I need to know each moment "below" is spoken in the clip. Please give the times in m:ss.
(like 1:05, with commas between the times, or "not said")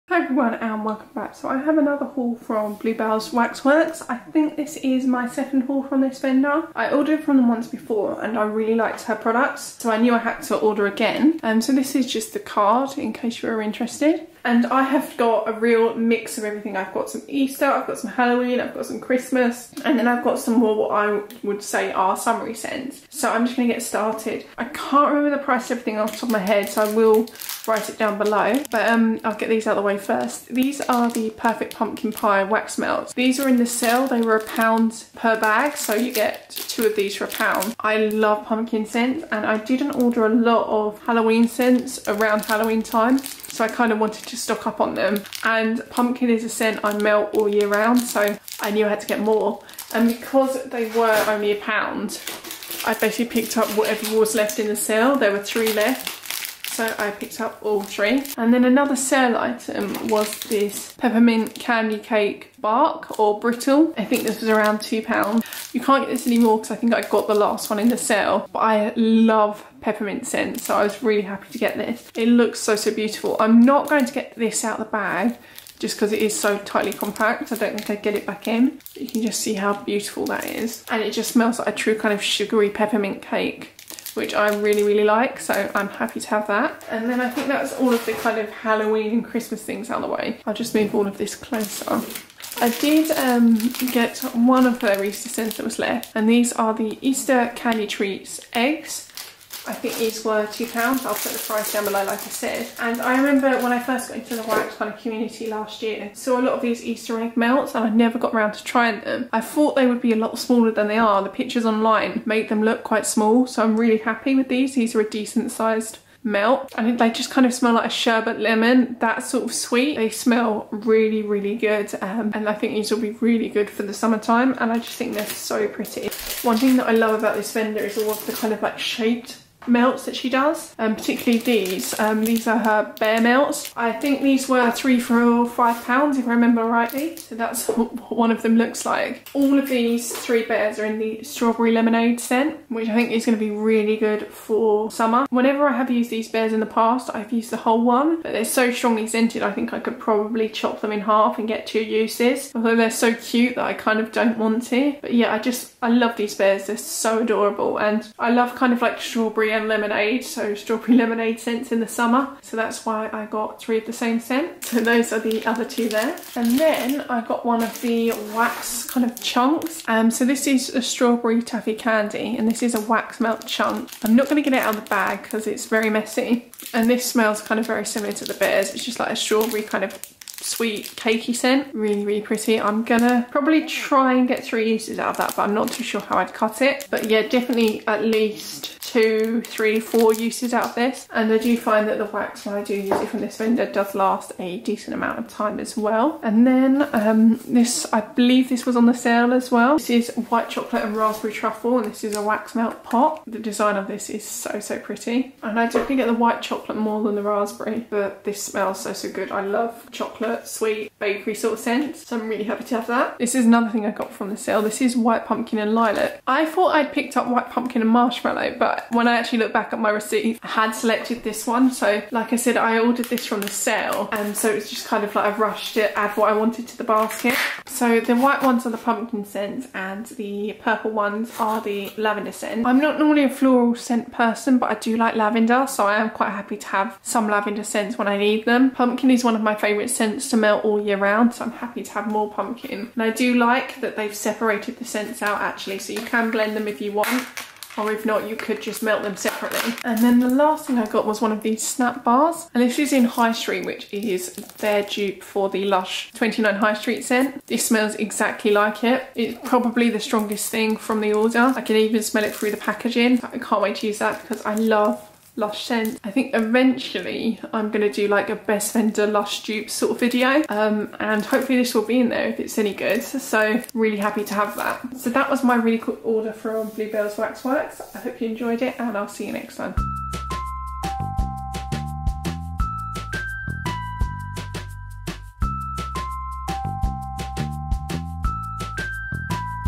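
0:28, 1:41.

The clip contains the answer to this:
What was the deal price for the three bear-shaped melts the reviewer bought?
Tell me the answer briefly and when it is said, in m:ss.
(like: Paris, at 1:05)
3 for £5, at 2:14.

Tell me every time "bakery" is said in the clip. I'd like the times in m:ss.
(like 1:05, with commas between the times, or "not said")
3:30.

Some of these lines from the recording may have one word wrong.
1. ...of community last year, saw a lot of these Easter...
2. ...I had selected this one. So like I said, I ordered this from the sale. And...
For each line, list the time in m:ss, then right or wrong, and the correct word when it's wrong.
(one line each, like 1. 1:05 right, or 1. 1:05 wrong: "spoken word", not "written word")
1. 1:44 right
2. 3:40 right.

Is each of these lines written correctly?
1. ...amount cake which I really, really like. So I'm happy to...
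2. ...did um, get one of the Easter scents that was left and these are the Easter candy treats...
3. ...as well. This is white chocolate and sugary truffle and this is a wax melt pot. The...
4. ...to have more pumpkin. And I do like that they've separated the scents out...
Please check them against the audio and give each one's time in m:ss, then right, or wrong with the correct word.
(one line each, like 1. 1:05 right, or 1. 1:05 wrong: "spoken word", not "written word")
1. 1:22 wrong: "peppermint", not "amount"
2. 1:32 right
3. 3:19 wrong: "raspberry", not "sugary"
4. 4:01 right.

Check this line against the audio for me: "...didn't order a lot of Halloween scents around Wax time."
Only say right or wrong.
wrong.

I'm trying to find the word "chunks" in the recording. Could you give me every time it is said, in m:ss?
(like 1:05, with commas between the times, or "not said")
2:49, 2:53.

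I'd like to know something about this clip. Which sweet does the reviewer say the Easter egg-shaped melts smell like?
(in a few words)
sherbet lemon.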